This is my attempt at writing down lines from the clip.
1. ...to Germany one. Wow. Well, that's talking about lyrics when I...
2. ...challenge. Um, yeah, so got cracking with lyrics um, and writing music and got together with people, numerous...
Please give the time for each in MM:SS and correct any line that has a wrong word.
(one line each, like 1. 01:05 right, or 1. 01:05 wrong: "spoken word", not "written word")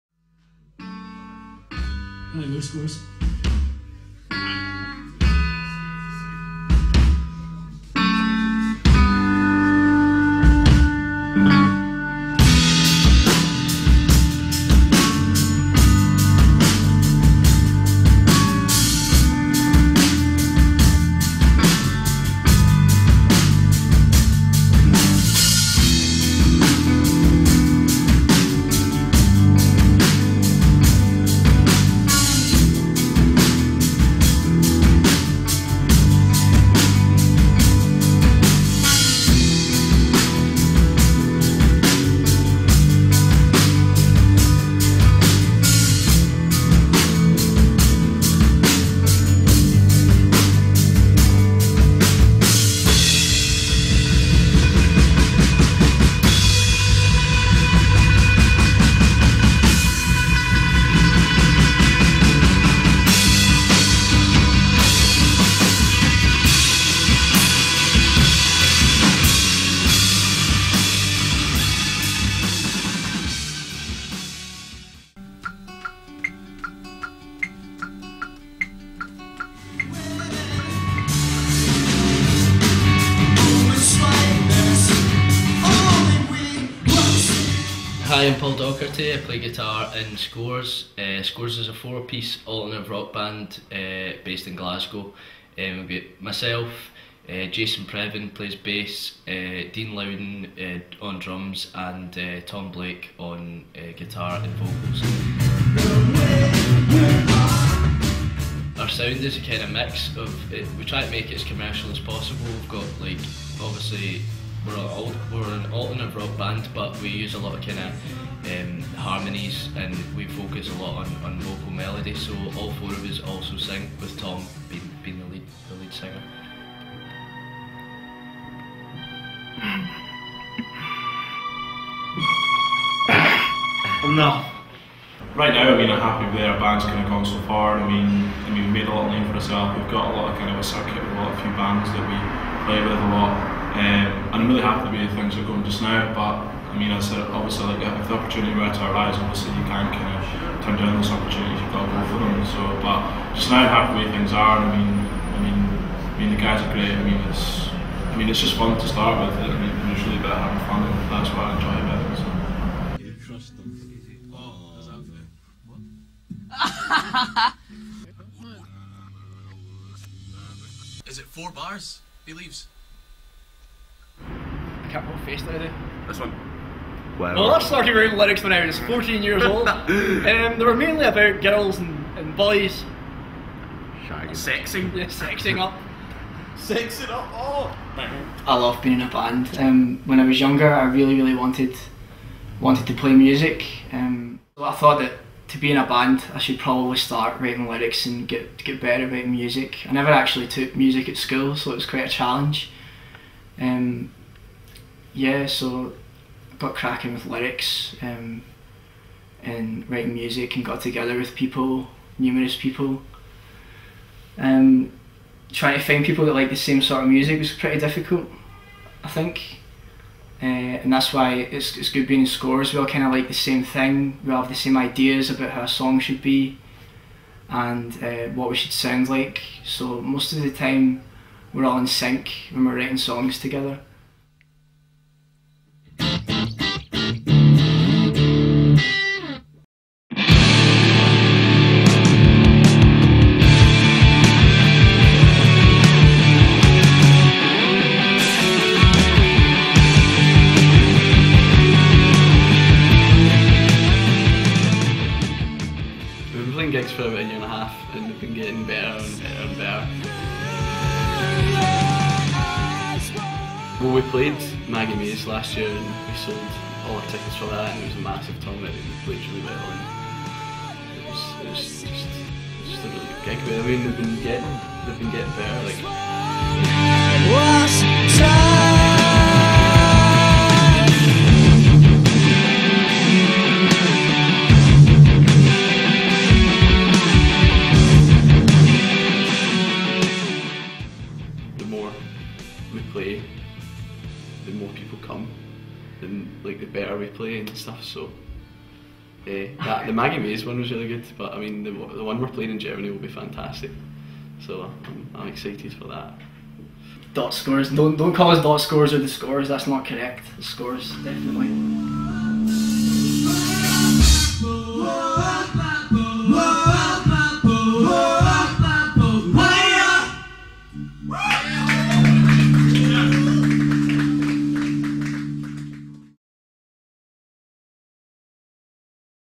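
1. 02:55 wrong: "This", not "Germany"
2. 03:22 right.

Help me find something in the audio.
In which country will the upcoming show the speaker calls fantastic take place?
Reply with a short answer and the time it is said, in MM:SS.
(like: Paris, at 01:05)
Germany, at 05:02.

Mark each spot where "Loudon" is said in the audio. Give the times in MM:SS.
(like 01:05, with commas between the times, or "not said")
01:39.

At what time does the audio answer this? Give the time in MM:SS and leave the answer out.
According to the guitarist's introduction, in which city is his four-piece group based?
01:34.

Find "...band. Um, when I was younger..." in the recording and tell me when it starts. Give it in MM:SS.
03:09.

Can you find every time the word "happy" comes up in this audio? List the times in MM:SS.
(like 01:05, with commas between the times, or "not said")
02:16, 02:24, 02:33.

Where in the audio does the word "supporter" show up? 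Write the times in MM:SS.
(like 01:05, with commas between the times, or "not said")
not said.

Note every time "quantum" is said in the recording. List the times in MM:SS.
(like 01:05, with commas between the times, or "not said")
not said.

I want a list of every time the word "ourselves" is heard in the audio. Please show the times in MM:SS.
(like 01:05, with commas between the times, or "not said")
02:19.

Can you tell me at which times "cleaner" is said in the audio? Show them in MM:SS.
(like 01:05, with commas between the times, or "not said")
not said.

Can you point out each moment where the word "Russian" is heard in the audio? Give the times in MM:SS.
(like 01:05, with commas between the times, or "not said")
not said.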